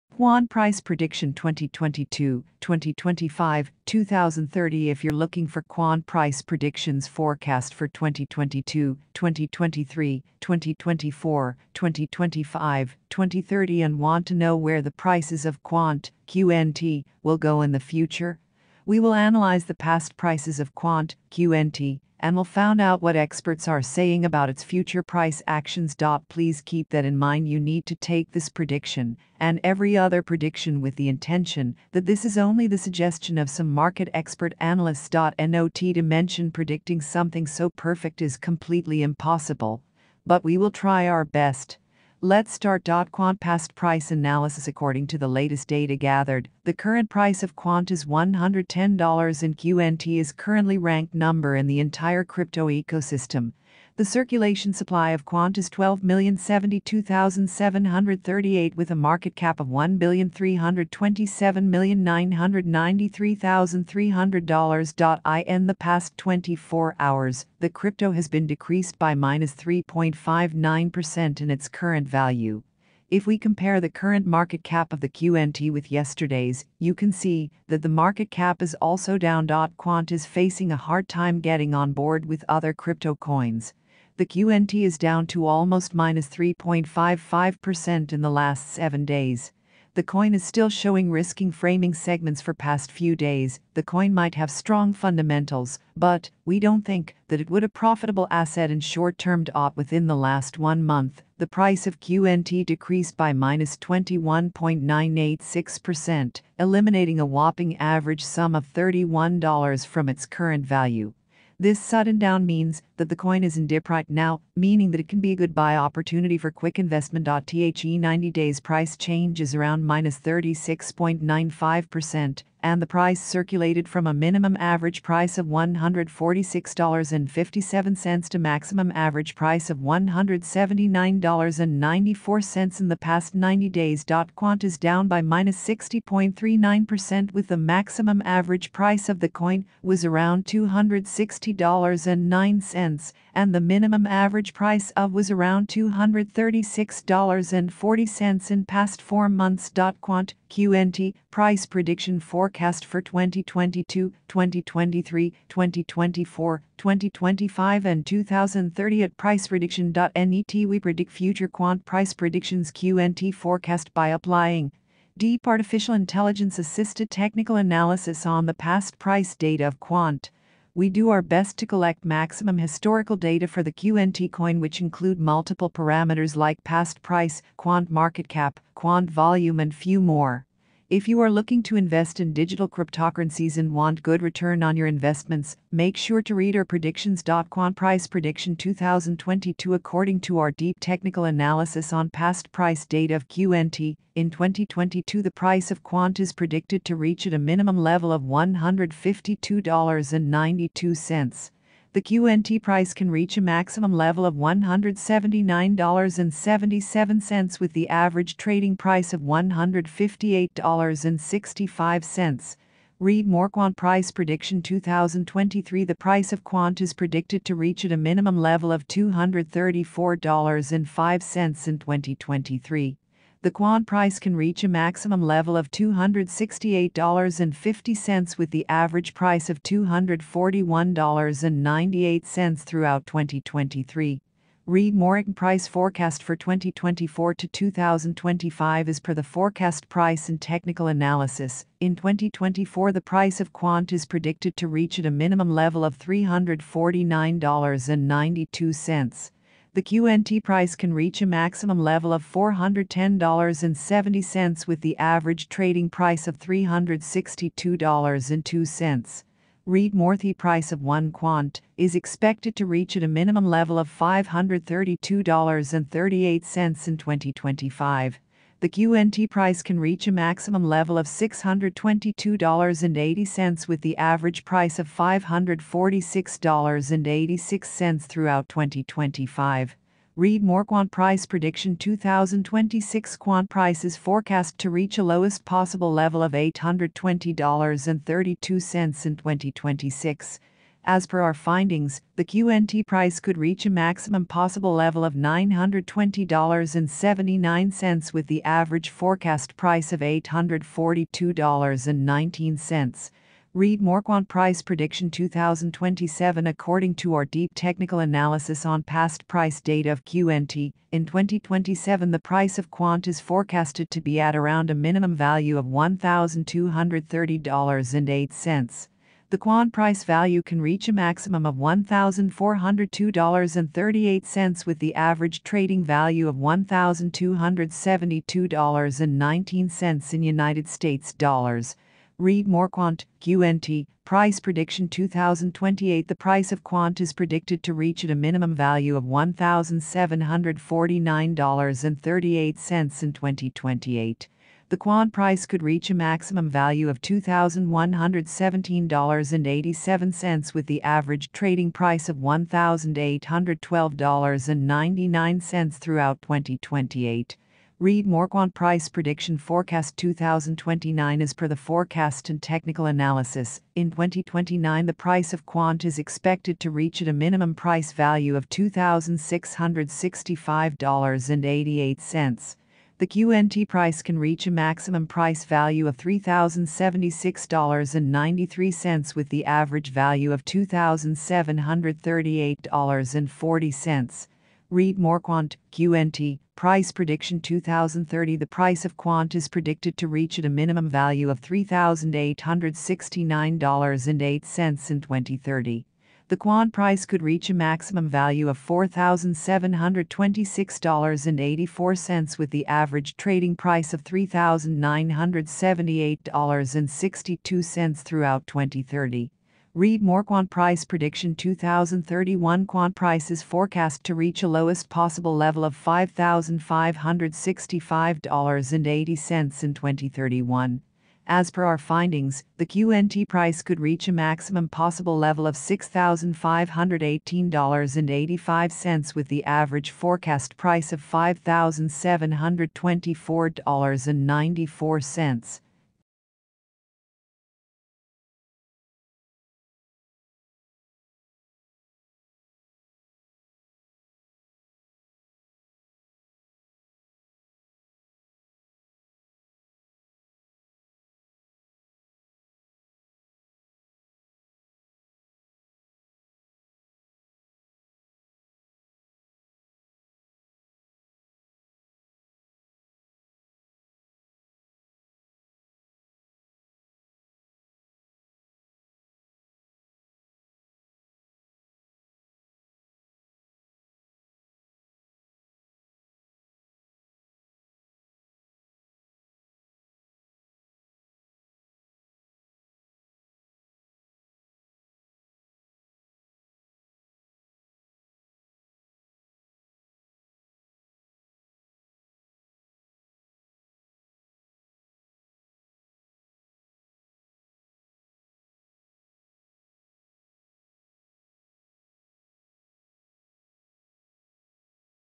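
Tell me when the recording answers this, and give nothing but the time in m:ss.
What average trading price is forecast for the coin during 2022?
3:29.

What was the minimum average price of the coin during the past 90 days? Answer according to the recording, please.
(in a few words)
$146.57.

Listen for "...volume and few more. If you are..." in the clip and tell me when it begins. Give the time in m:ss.
2:59.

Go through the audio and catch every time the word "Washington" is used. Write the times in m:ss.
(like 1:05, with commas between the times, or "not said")
not said.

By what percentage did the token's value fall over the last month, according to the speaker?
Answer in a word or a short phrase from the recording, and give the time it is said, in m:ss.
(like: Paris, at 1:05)
-21.986%, at 1:43.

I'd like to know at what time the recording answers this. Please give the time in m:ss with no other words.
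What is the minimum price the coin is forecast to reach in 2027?
5:15.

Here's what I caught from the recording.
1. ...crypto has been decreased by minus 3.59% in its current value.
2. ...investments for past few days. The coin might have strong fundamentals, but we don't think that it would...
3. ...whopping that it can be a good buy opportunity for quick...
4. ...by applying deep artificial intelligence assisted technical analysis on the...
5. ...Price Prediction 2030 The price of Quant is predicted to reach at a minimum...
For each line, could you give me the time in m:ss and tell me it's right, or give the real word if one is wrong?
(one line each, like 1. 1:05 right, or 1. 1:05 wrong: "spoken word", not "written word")
1. 1:07 right
2. 1:31 wrong: "segments", not "investments"
3. 1:54 wrong: "meaning", not "whopping"
4. 2:43 right
5. 6:26 right.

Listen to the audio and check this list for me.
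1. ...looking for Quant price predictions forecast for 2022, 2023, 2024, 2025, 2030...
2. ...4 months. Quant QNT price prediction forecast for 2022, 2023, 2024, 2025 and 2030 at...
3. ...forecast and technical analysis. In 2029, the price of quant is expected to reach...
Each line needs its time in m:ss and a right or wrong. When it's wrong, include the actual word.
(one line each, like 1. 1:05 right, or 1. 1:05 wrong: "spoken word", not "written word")
1. 0:05 right
2. 2:29 right
3. 6:01 right.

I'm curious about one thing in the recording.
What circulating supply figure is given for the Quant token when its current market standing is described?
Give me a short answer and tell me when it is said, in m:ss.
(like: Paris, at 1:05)
12,072,738, at 0:55.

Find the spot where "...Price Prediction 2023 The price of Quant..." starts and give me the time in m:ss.
3:33.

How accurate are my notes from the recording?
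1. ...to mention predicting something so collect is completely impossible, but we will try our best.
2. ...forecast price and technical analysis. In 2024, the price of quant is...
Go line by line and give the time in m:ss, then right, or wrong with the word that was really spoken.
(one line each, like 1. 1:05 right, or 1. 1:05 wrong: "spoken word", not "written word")
1. 0:35 wrong: "perfect", not "collect"
2. 3:59 right.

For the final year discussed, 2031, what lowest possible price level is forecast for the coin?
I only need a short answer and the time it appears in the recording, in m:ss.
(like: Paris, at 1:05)
$5,565.80, at 6:55.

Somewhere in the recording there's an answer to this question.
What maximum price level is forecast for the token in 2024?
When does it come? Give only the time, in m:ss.
4:12.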